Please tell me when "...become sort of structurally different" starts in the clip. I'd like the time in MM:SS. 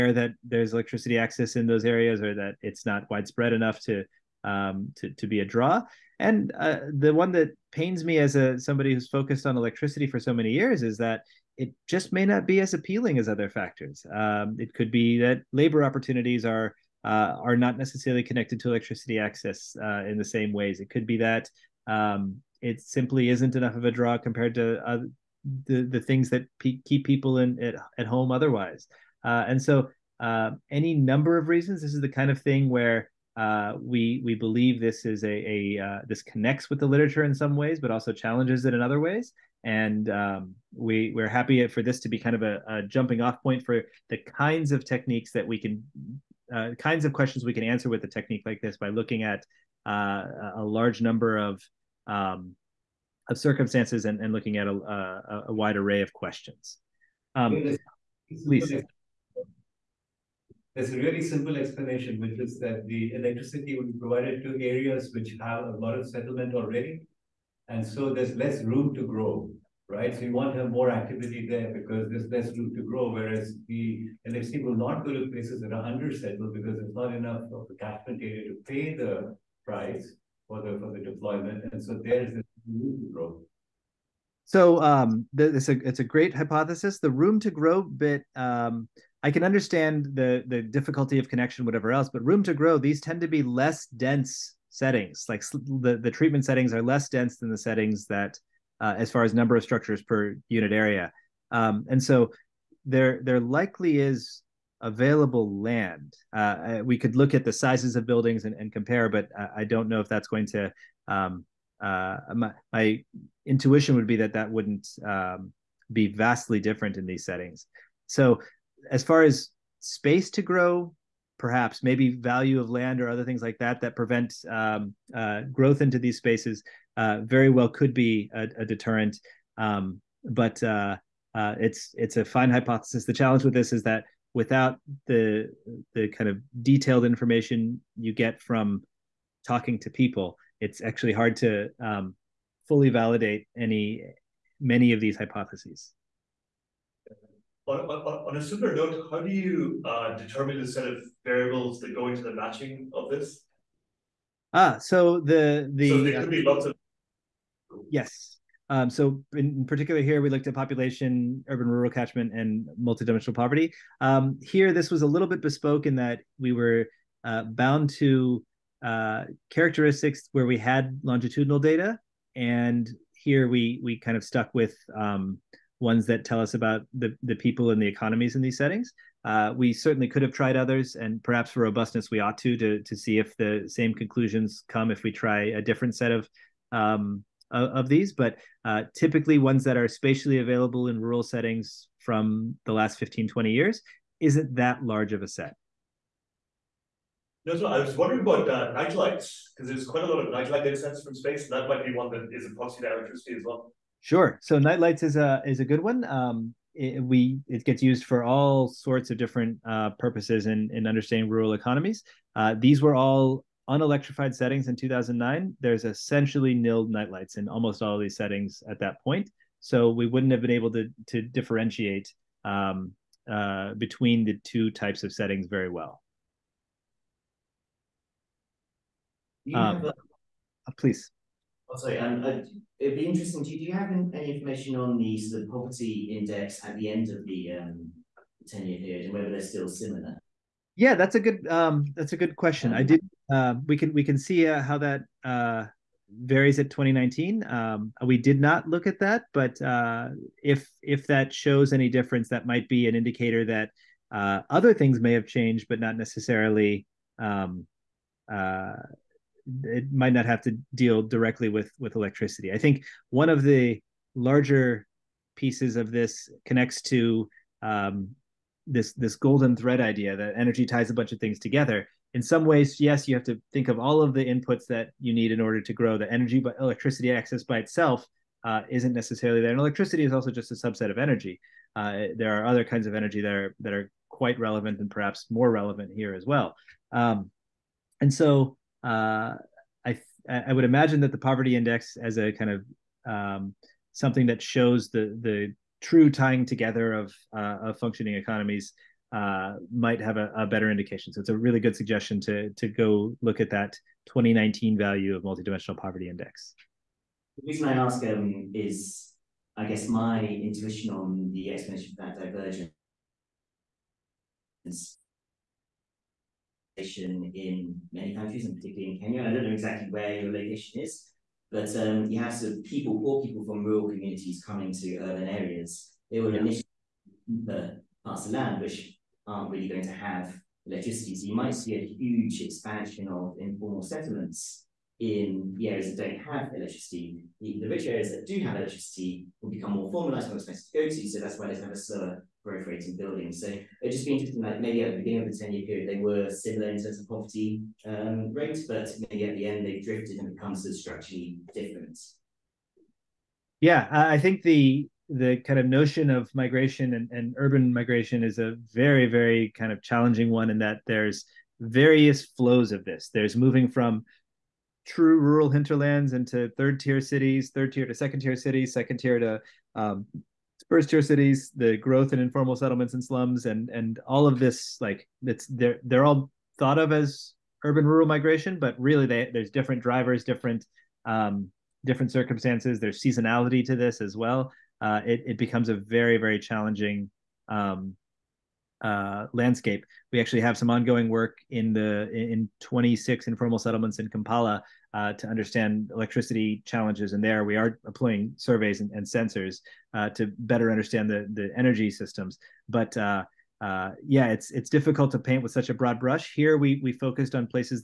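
05:50.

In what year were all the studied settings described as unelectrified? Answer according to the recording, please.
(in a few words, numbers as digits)
2009.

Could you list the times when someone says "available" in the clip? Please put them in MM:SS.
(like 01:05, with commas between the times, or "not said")
01:44, 03:10.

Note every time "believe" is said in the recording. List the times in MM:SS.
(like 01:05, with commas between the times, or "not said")
00:34.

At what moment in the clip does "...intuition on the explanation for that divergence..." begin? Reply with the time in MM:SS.
05:10.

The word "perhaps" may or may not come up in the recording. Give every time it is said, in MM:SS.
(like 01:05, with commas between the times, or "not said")
02:01, 03:01, 04:44.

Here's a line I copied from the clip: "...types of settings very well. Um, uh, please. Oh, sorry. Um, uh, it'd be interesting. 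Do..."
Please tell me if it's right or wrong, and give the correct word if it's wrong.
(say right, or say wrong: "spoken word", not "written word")
right.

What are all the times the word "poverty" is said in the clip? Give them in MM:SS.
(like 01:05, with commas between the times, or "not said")
02:43, 03:55, 04:51, 05:05.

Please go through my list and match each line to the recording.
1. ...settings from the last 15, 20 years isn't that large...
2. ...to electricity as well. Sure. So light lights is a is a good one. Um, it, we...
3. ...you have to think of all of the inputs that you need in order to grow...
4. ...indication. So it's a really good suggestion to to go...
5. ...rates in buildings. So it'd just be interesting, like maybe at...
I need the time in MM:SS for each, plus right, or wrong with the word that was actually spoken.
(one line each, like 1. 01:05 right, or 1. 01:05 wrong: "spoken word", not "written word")
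1. 03:11 right
2. 03:22 wrong: "night", not "light"
3. 04:33 right
4. 05:00 right
5. 05:42 right.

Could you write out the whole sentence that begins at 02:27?
On, on, on a similar note, how do you uh, determine the set of variables that go into the matching of this?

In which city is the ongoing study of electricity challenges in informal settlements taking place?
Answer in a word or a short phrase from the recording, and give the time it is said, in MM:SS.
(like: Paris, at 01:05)
Kampala, at 06:34.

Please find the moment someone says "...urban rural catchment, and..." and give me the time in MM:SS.
02:41.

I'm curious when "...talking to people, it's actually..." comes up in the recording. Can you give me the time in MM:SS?
02:19.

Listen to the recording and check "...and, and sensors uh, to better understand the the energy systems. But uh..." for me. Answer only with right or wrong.
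right.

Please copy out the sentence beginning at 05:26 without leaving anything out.
They will initially the parts of land which aren't really going to have electricity.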